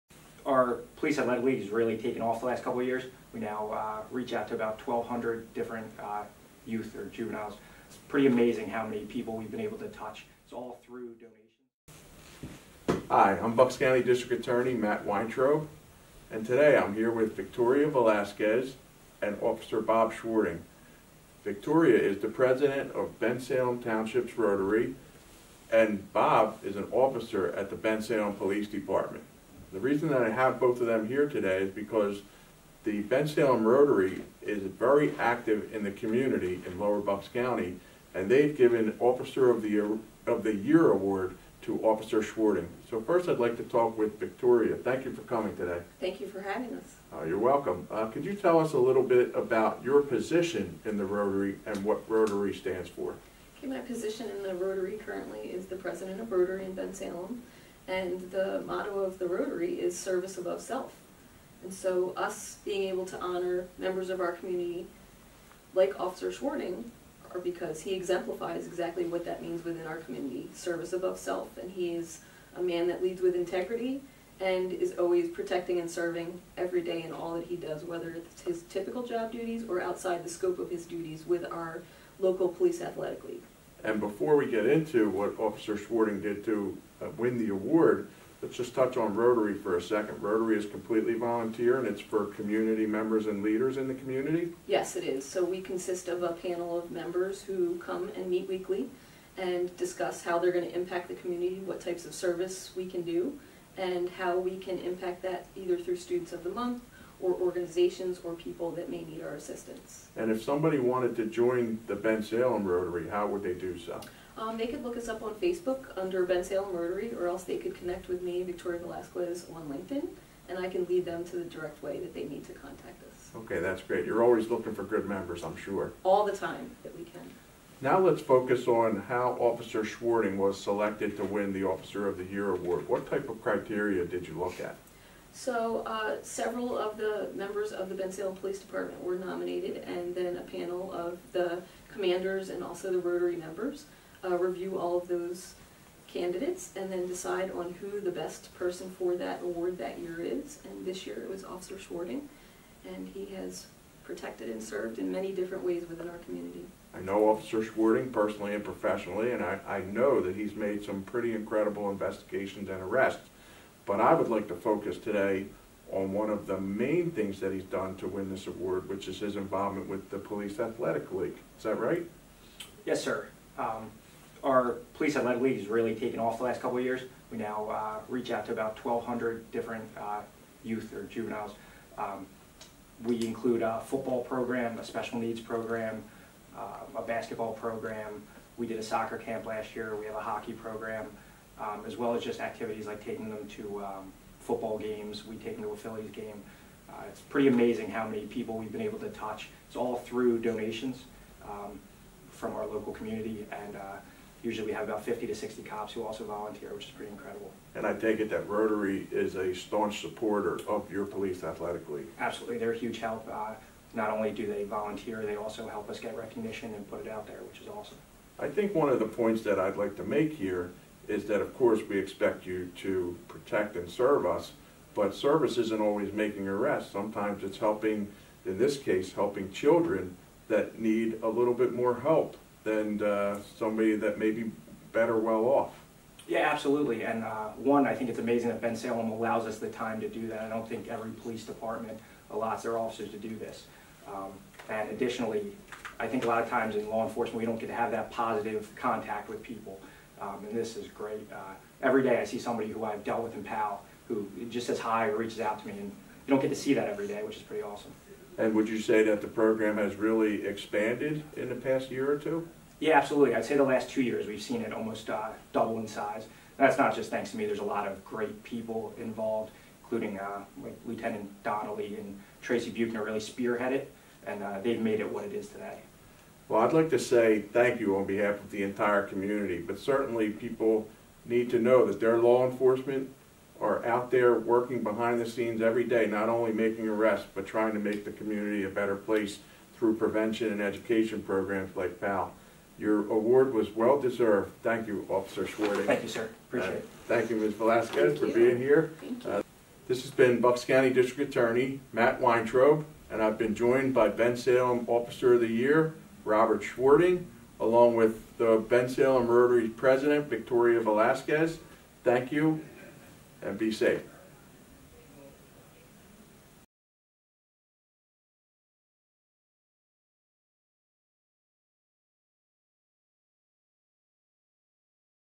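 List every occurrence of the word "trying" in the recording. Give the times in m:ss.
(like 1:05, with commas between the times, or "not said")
4:47.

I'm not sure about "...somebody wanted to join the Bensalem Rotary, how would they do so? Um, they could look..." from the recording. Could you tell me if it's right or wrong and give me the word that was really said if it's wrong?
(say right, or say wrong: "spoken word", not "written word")
right.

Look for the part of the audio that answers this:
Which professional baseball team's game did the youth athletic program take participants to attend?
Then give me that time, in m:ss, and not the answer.
3:15.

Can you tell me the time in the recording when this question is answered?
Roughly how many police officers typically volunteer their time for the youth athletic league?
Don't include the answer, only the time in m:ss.
3:25.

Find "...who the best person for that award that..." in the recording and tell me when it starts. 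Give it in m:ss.
2:27.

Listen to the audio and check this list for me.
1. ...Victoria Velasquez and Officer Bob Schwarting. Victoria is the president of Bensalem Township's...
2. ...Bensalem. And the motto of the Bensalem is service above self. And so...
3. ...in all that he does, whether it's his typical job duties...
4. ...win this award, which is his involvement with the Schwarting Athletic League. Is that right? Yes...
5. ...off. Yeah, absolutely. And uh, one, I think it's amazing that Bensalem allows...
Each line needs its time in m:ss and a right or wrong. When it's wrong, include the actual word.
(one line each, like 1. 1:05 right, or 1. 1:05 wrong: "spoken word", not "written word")
1. 0:17 right
2. 0:56 wrong: "Rotary", not "Bensalem"
3. 1:17 right
4. 2:48 wrong: "Police", not "Schwarting"
5. 3:55 right.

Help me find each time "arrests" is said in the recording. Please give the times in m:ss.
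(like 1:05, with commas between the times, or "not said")
2:42, 3:46, 4:46.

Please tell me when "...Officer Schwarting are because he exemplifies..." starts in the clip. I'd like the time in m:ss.
1:05.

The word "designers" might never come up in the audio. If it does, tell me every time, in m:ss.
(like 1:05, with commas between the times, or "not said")
not said.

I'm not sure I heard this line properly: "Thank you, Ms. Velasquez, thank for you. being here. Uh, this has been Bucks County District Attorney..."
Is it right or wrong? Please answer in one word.
right.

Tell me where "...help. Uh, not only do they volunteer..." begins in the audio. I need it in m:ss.
3:32.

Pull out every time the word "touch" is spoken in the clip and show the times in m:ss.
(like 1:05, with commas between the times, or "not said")
0:09, 1:28, 3:19.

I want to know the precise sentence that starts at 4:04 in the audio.
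Um, and additionally, I think a lot of times in law enforcement, we don't get to have that positive contact with people.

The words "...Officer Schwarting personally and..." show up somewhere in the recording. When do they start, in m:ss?
2:37.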